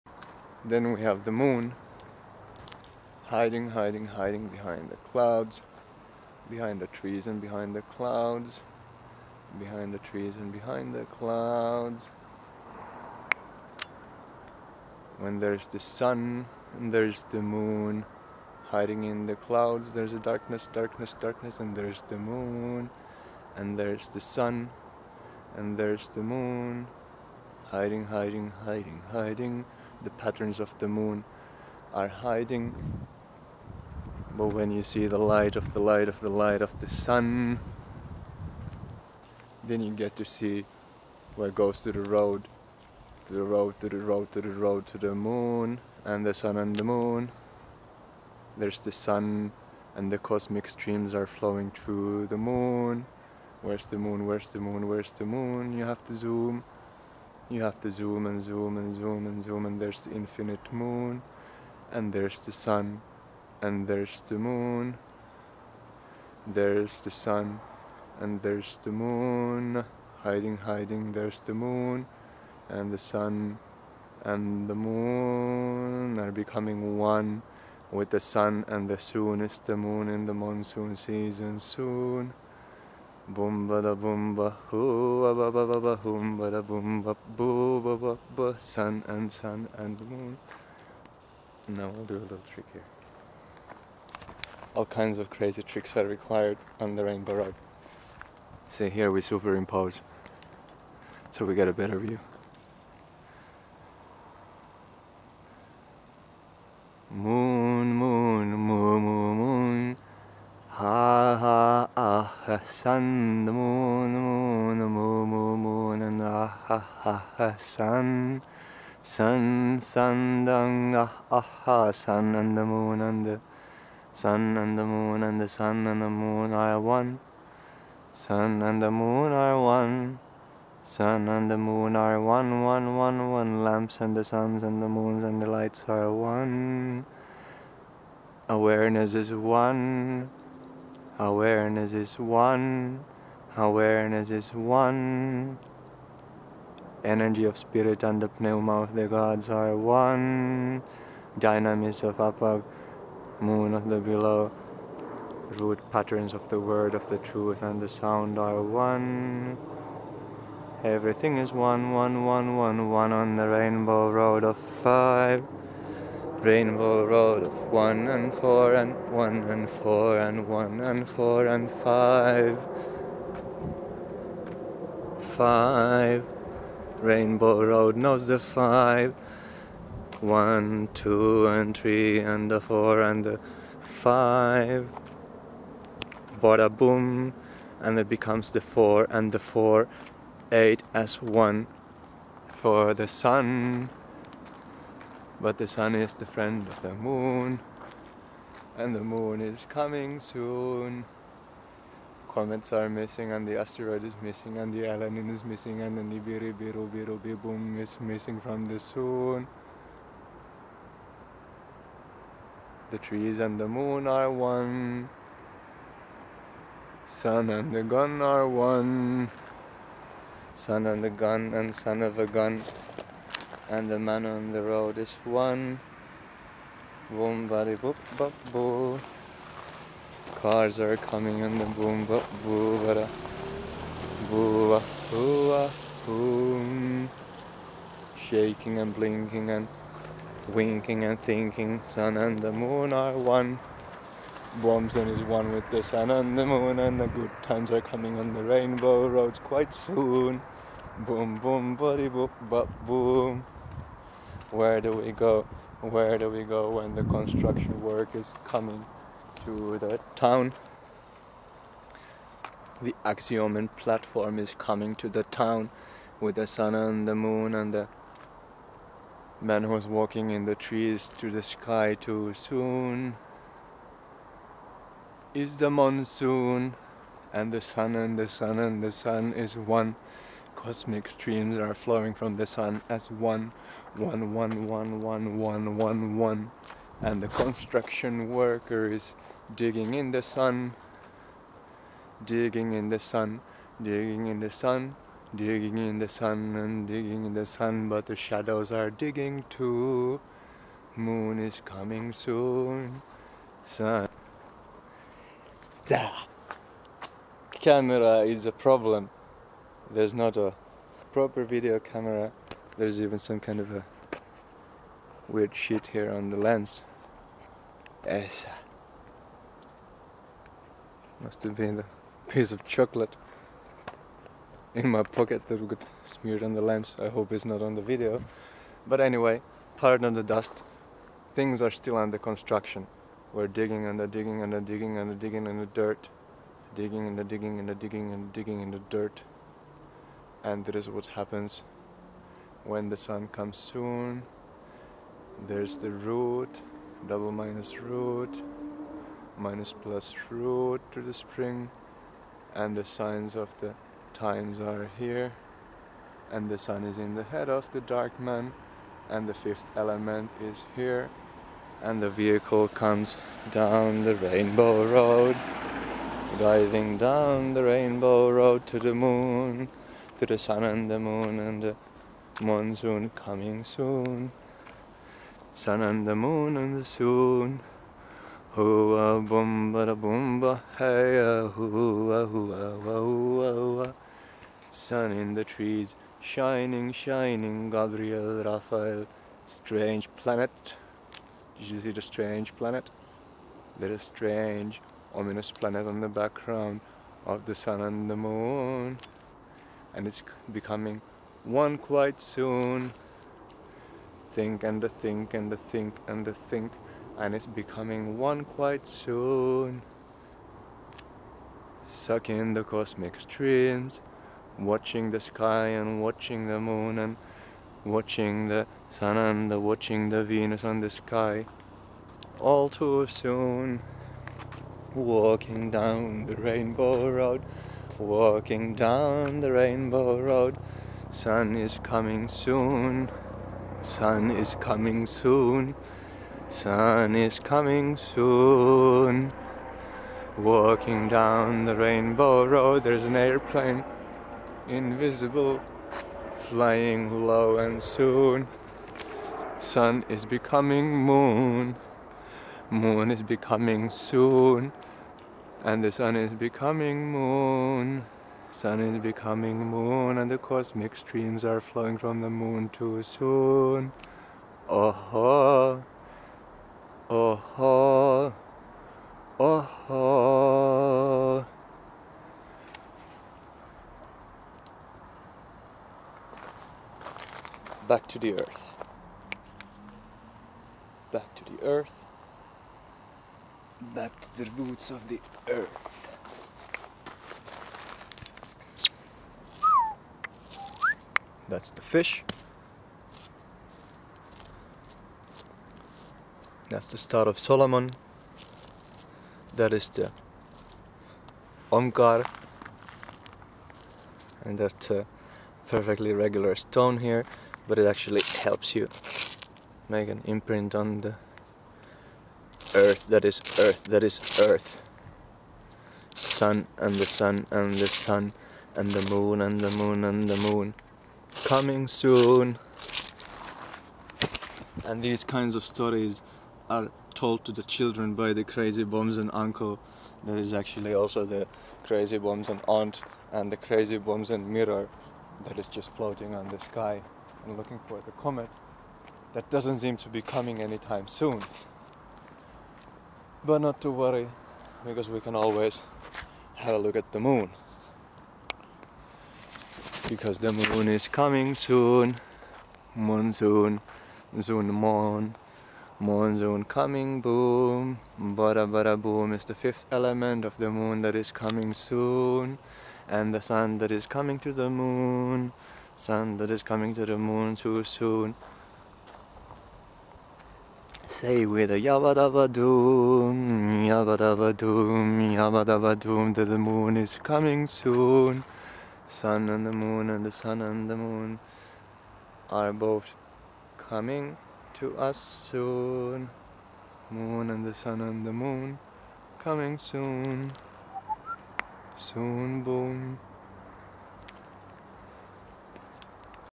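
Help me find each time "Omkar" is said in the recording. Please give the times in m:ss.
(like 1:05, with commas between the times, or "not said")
8:21.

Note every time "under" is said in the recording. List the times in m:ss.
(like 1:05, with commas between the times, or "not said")
5:31.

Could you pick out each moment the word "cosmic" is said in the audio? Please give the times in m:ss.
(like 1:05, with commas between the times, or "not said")
0:50, 4:40, 6:52, 7:40.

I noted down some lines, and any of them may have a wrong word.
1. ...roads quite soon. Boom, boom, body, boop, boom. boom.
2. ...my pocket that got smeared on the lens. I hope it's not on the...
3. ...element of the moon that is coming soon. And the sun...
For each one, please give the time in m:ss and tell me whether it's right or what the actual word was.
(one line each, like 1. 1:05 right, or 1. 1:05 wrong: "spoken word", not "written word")
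1. 4:09 right
2. 5:24 right
3. 9:19 right.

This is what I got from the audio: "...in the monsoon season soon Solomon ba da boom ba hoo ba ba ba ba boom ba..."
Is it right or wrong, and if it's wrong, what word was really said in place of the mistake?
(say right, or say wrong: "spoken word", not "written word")
wrong: "Boom", not "Solomon".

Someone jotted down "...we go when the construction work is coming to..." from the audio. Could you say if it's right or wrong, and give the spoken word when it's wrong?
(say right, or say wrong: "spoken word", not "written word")
right.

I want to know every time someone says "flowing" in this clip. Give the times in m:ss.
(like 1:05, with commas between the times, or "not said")
0:51, 4:41, 7:41.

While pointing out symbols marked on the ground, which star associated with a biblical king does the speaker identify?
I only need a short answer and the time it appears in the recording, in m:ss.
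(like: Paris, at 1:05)
Star of Solomon, at 8:16.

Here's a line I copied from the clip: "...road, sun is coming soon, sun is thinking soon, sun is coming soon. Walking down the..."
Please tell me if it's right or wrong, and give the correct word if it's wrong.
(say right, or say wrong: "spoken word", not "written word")
wrong: "coming", not "thinking".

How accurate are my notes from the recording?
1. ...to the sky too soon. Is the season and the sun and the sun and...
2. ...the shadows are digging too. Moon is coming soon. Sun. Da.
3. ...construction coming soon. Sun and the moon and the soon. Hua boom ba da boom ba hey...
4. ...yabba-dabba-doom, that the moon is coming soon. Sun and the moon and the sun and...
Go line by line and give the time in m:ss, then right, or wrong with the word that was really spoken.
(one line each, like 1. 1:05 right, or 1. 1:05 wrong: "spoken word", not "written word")
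1. 4:31 wrong: "monsoon", not "season"
2. 4:58 right
3. 6:12 wrong: "monsoon", not "construction"
4. 9:35 right.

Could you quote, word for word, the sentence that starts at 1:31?
Now we will do a little trick here.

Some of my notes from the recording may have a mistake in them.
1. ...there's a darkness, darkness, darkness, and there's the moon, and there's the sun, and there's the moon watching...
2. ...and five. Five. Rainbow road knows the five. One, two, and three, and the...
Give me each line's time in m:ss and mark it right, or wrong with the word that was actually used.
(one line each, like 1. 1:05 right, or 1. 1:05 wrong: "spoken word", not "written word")
1. 0:19 wrong: "hiding", not "watching"
2. 2:51 right.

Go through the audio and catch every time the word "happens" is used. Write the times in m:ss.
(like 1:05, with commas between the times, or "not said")
5:41.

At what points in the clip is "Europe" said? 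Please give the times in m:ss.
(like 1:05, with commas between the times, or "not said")
not said.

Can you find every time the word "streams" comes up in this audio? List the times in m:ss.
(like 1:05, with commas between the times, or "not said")
0:50, 4:41, 6:53, 7:40.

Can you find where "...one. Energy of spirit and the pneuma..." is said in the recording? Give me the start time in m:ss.
2:24.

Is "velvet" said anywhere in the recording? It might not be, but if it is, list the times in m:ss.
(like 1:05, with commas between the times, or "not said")
not said.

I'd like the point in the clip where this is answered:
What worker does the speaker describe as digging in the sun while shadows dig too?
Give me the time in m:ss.
4:47.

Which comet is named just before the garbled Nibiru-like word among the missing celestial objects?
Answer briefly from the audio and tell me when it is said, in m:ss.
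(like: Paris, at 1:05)
Elenin, at 3:24.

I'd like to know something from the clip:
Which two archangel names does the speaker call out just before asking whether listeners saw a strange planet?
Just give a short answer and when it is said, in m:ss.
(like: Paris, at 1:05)
Gabriel, Raphael, at 6:27.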